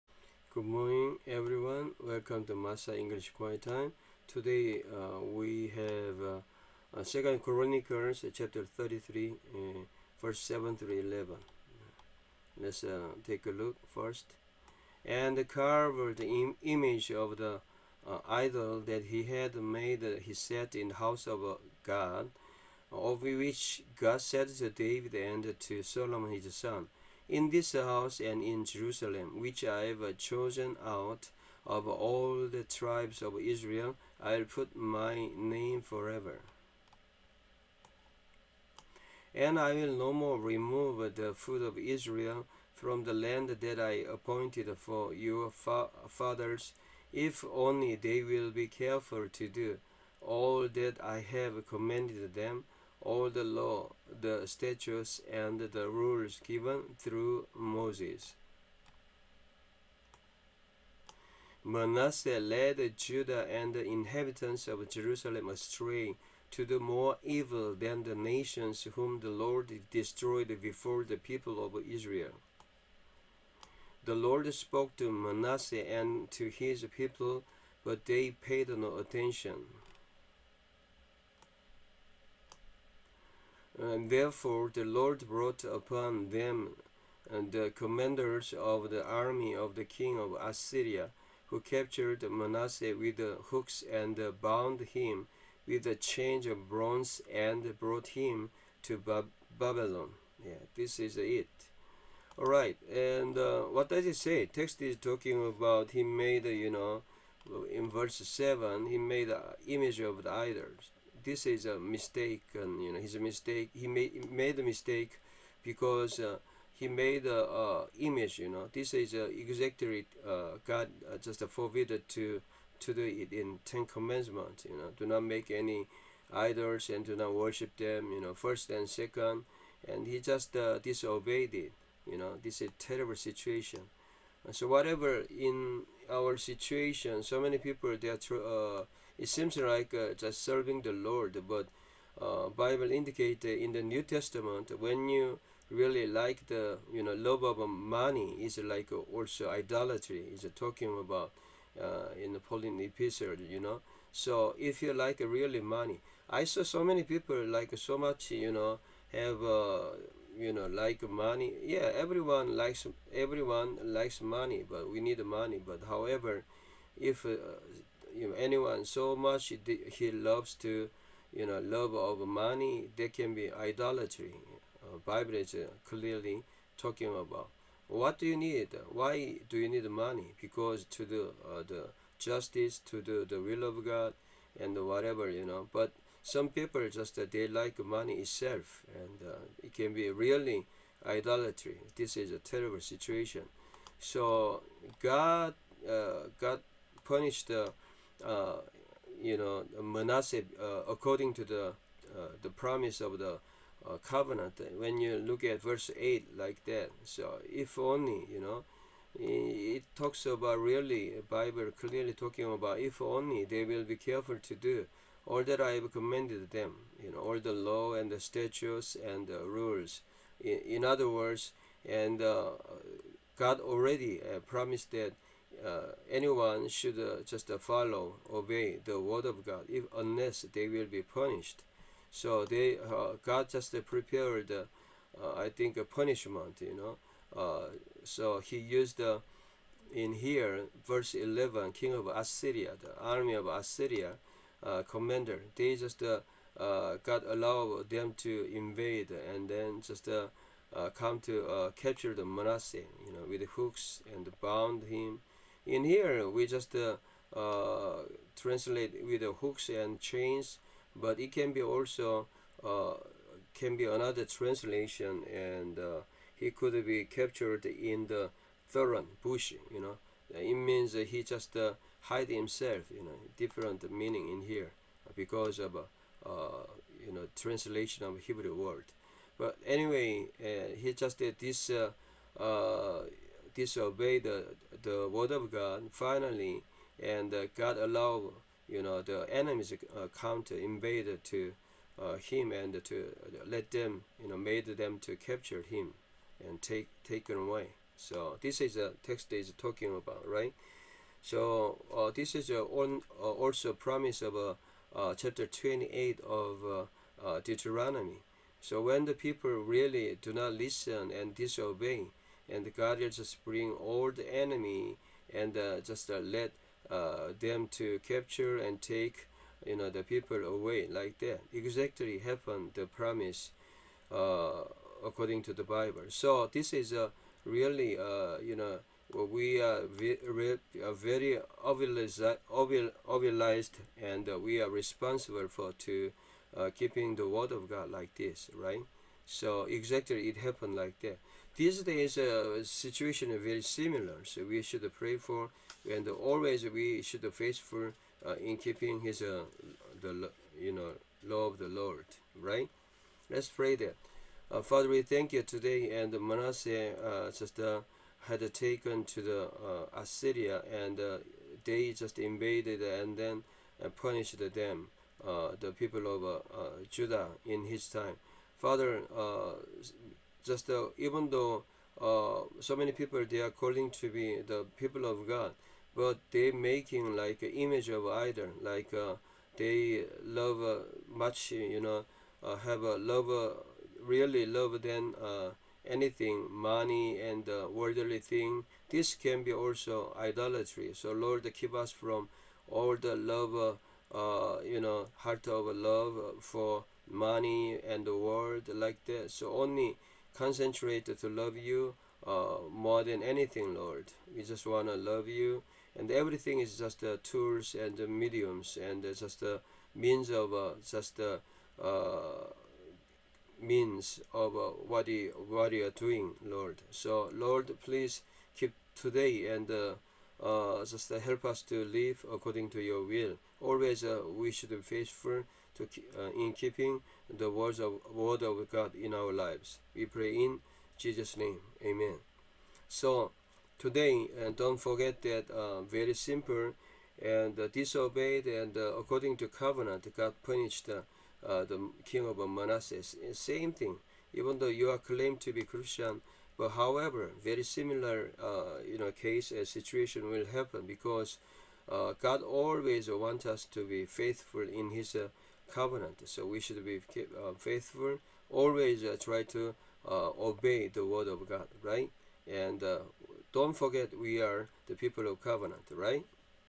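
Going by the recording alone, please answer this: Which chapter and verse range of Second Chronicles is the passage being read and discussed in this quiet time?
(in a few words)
Chapter 33, verses 7-11.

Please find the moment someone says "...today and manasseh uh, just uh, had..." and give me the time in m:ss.
5:55.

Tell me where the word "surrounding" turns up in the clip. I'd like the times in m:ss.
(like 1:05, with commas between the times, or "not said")
not said.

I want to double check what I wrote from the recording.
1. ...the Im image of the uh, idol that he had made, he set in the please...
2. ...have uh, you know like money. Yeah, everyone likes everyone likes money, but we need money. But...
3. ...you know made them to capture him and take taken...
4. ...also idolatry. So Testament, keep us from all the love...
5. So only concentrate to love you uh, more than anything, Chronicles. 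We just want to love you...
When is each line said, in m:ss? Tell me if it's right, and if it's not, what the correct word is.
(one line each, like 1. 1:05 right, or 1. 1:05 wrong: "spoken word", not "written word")
1. 0:16 wrong: "house", not "please"
2. 2:39 right
3. 4:54 right
4. 6:29 wrong: "Lord", not "Testament"
5. 6:39 wrong: "Lord", not "Chronicles".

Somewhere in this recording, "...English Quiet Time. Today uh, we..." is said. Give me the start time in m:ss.
0:02.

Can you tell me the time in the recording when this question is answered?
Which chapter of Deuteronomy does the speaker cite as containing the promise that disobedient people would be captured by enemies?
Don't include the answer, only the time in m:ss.
5:05.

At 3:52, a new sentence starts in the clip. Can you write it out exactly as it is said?
So they, uh, God just uh, prepared, I think, a punishment.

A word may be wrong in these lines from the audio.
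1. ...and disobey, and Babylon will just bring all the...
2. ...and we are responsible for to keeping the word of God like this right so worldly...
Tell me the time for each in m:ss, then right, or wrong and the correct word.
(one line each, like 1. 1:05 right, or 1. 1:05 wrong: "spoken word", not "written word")
1. 5:11 wrong: "God", not "Babylon"
2. 5:34 wrong: "exactly", not "worldly".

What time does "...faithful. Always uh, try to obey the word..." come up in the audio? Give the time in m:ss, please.
7:37.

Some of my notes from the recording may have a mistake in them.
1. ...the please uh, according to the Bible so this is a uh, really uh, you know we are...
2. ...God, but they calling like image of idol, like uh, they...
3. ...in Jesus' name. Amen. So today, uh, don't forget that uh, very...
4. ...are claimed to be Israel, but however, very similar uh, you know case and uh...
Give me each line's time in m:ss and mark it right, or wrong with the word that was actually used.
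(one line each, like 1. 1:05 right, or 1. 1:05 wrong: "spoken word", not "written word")
1. 5:22 wrong: "promise", not "please"
2. 6:15 wrong: "making", not "calling"
3. 7:10 right
4. 7:24 wrong: "Christian", not "Israel".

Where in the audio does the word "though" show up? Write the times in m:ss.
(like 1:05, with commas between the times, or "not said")
6:11, 7:24.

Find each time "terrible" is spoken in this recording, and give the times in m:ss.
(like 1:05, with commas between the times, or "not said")
2:12, 3:12.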